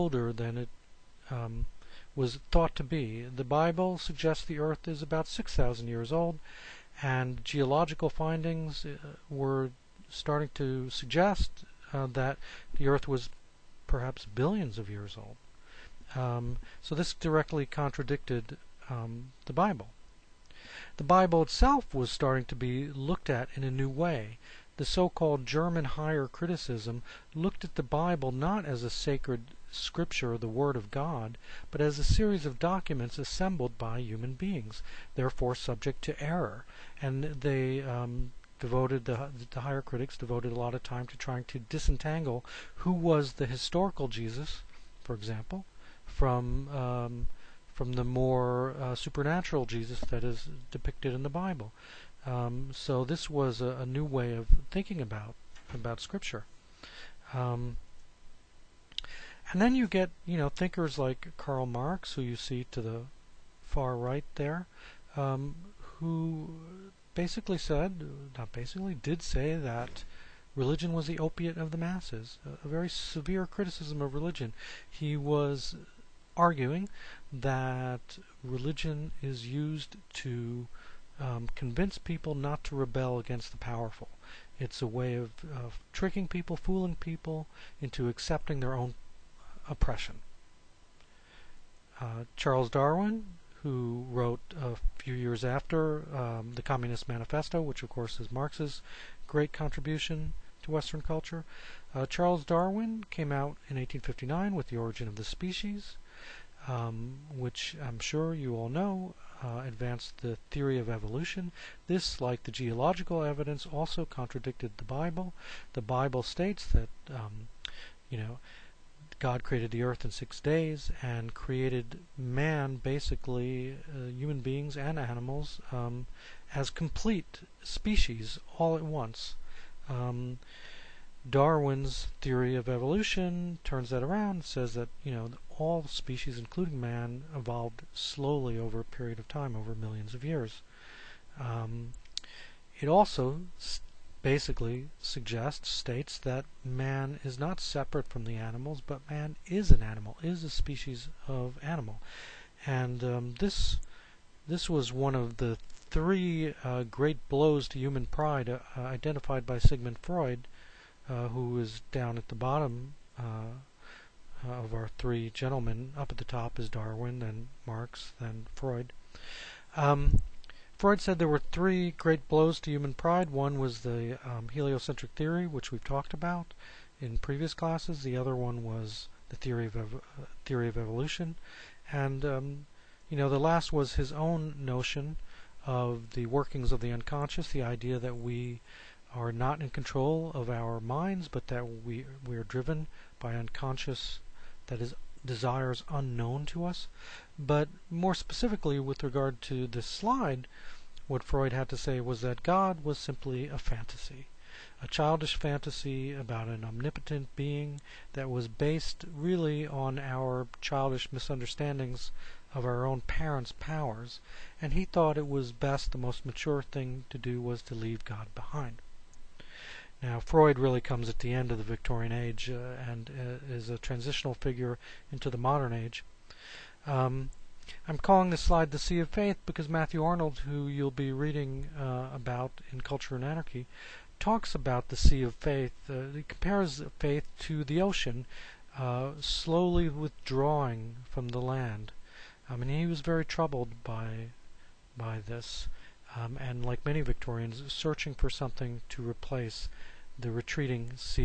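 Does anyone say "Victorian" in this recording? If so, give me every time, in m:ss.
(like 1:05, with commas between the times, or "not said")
3:41, 4:07.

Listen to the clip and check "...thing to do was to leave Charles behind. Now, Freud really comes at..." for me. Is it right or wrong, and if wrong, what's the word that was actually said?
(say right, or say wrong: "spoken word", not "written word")
wrong: "God", not "Charles".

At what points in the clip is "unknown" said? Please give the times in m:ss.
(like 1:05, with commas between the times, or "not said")
3:15.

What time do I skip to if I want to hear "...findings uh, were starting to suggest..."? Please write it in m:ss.
0:08.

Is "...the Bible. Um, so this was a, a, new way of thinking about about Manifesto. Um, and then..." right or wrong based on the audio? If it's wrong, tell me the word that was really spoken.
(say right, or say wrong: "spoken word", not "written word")
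wrong: "Scripture", not "Manifesto".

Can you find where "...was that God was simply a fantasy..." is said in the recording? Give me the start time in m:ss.
3:22.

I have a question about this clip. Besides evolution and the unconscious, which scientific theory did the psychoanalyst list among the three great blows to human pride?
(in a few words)
heliocentric theory.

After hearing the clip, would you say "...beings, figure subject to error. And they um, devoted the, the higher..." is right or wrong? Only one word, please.
wrong.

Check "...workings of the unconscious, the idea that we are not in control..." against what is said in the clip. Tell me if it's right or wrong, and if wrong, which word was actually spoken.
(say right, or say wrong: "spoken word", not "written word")
right.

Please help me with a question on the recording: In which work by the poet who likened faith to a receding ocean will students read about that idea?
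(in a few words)
Culture and Anarchy.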